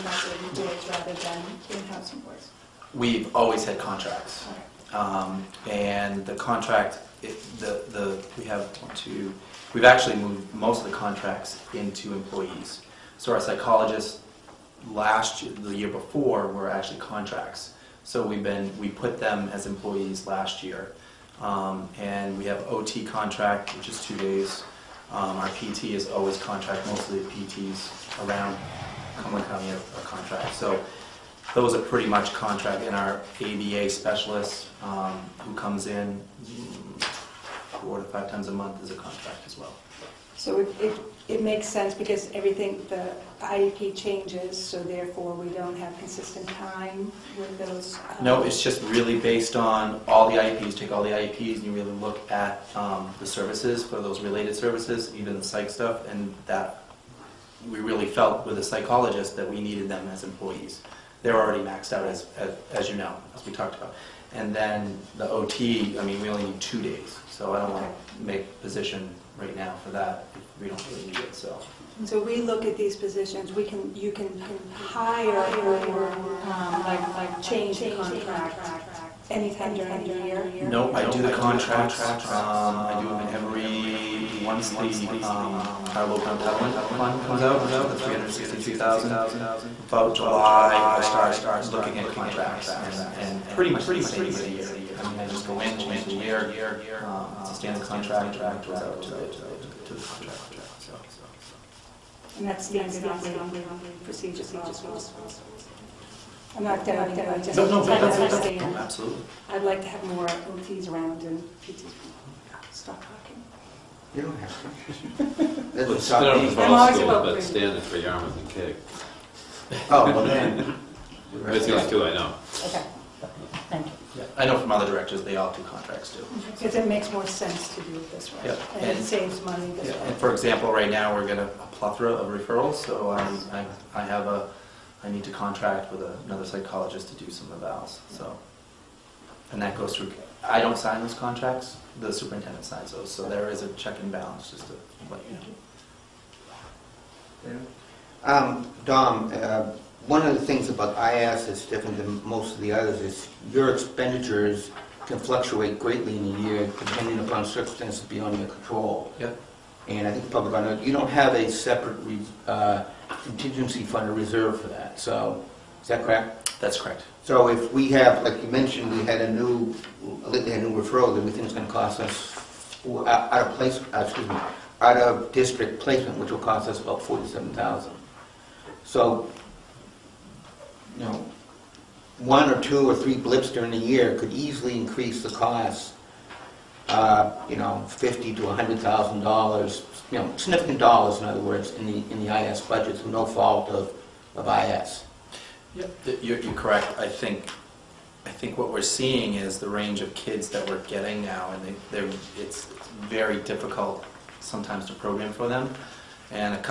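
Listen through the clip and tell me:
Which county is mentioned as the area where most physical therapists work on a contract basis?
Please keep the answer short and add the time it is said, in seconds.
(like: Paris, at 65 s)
Cumberland County, at 29 s.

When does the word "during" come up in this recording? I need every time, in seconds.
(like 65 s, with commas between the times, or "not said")
79 s, 183 s.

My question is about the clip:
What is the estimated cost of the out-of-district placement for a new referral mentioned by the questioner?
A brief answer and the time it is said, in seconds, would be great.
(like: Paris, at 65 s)
$47,000, at 177 s.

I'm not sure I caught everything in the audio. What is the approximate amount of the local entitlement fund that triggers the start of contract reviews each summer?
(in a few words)
$363,000.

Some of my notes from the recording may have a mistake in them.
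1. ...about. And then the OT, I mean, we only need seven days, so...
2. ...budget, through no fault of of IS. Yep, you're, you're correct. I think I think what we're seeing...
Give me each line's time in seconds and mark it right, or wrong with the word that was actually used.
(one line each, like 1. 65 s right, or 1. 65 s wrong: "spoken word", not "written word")
1. 63 s wrong: "two", not "seven"
2. 192 s right.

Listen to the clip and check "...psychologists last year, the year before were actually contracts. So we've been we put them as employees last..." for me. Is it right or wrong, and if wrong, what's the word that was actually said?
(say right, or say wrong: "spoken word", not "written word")
right.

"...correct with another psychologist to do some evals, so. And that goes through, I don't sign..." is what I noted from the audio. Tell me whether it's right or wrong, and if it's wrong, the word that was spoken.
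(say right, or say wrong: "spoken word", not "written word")
wrong: "contract", not "correct".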